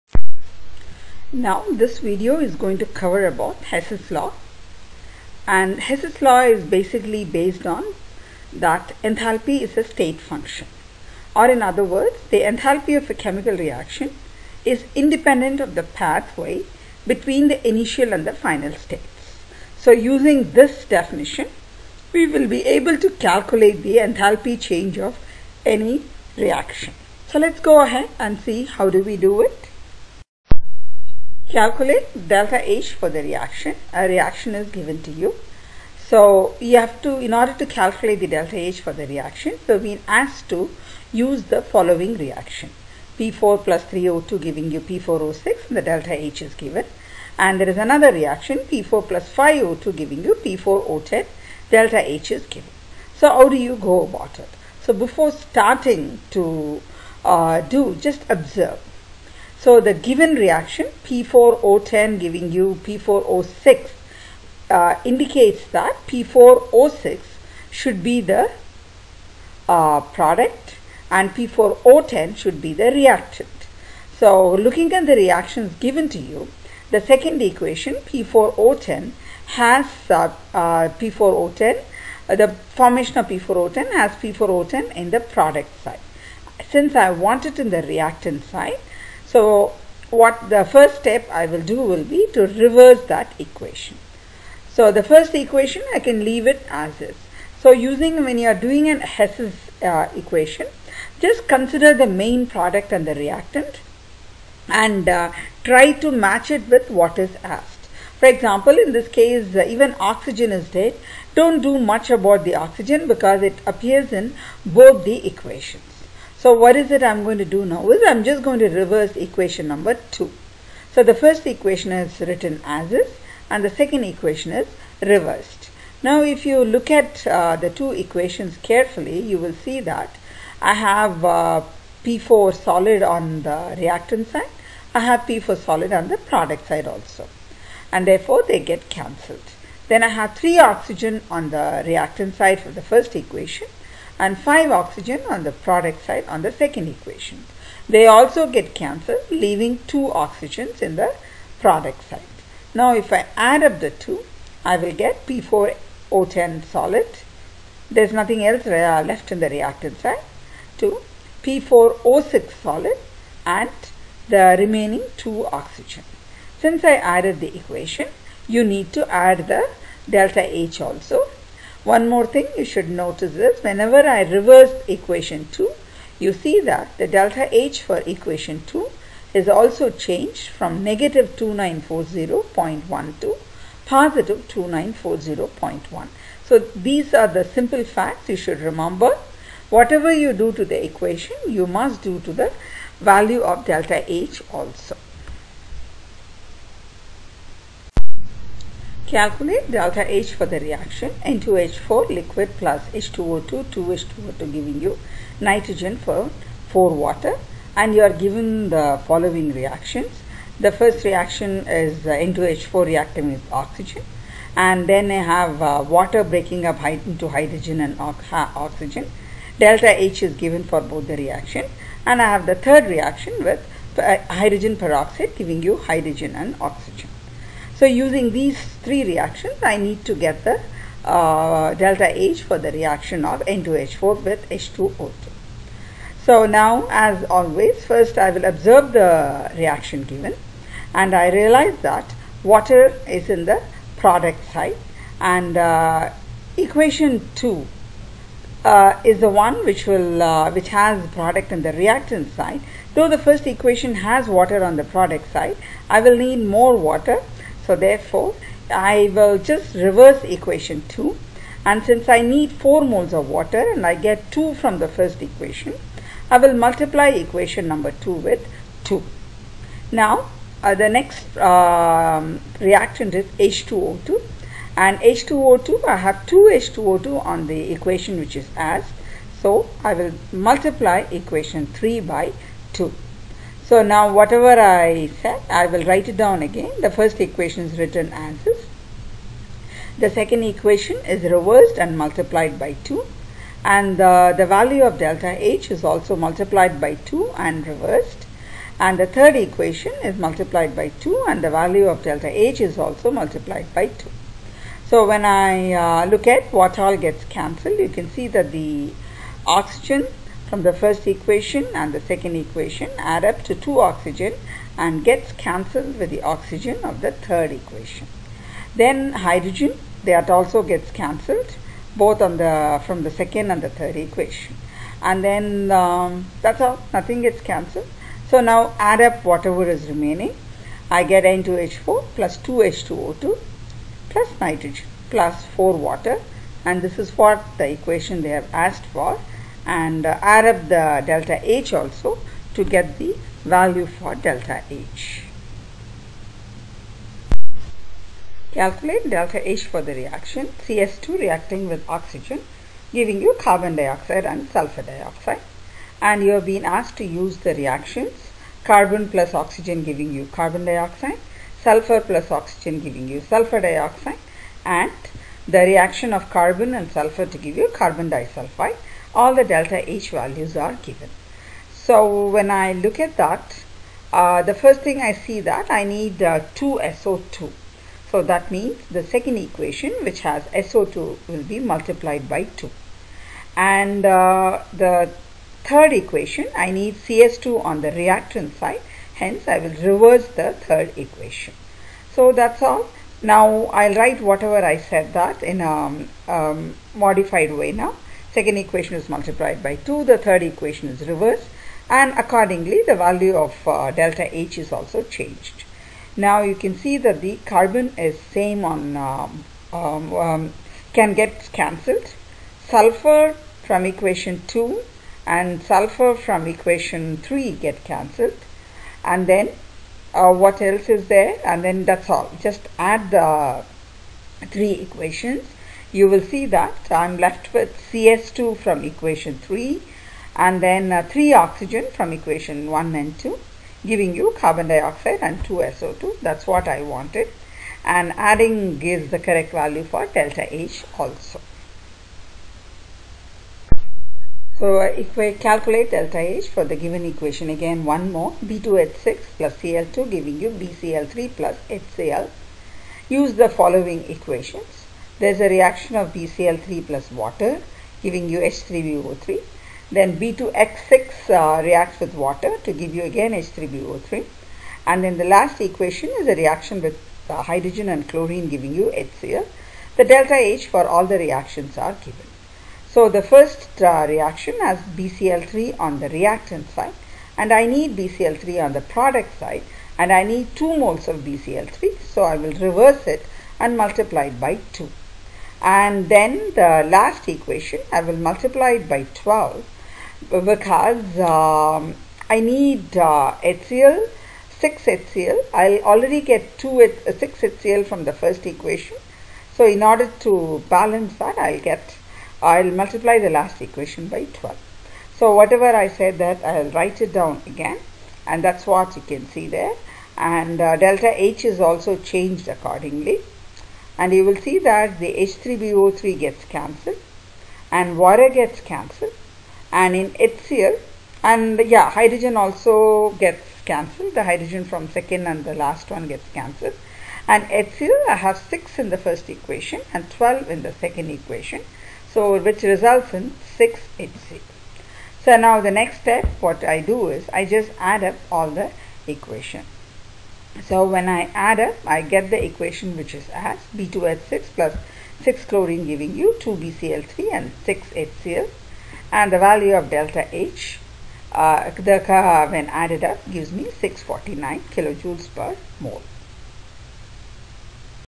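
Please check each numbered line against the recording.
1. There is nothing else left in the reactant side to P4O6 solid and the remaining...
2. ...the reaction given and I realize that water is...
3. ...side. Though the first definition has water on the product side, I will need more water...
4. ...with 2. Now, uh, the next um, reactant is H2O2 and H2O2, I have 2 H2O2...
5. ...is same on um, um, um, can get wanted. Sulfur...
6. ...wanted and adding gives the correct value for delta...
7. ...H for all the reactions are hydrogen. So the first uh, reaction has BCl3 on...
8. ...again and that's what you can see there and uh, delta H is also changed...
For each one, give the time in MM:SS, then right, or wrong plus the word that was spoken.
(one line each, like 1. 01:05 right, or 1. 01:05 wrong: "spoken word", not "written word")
1. 02:37 right
2. 03:58 right
3. 04:12 wrong: "equation", not "definition"
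4. 04:28 right
5. 06:47 wrong: "cancelled", not "wanted"
6. 07:16 right
7. 07:50 wrong: "given", not "hydrogen"
8. 08:27 right.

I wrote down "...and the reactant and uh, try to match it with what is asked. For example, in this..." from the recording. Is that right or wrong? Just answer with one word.
right.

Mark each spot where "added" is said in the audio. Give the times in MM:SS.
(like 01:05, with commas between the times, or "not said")
02:47, 09:12.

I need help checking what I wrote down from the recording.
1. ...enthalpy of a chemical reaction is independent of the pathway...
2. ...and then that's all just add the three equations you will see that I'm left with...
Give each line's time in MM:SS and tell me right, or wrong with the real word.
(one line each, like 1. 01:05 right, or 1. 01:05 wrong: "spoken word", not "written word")
1. 00:12 right
2. 07:01 right.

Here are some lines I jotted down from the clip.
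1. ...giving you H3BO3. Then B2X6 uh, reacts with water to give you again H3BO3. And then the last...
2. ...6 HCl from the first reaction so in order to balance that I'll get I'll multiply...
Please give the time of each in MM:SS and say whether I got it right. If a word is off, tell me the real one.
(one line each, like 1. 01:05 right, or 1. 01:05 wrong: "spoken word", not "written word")
1. 07:38 right
2. 08:17 wrong: "equation", not "reaction".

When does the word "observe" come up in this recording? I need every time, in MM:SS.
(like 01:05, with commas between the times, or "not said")
00:58, 03:58.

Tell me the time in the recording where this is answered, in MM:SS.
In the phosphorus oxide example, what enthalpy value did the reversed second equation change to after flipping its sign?
03:03.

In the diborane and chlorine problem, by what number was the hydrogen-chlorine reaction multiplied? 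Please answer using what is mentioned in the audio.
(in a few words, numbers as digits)
12.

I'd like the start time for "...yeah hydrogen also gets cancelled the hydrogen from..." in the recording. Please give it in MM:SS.
08:41.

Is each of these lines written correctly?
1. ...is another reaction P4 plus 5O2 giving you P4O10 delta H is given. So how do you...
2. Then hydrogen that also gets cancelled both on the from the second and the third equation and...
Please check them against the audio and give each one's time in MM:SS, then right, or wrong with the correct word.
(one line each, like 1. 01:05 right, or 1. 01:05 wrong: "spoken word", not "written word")
1. 00:47 right
2. 05:18 right.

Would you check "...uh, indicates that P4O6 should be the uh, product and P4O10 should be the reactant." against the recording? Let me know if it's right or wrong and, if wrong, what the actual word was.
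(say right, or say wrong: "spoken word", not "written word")
right.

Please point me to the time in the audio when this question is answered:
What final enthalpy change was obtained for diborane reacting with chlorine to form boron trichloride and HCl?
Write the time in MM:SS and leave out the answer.
09:13.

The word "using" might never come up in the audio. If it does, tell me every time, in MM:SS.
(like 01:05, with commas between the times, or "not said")
00:19, 01:37, 03:47.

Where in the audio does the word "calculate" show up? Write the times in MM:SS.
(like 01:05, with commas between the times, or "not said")
00:23, 00:31, 00:37, 03:19, 05:48, 07:25.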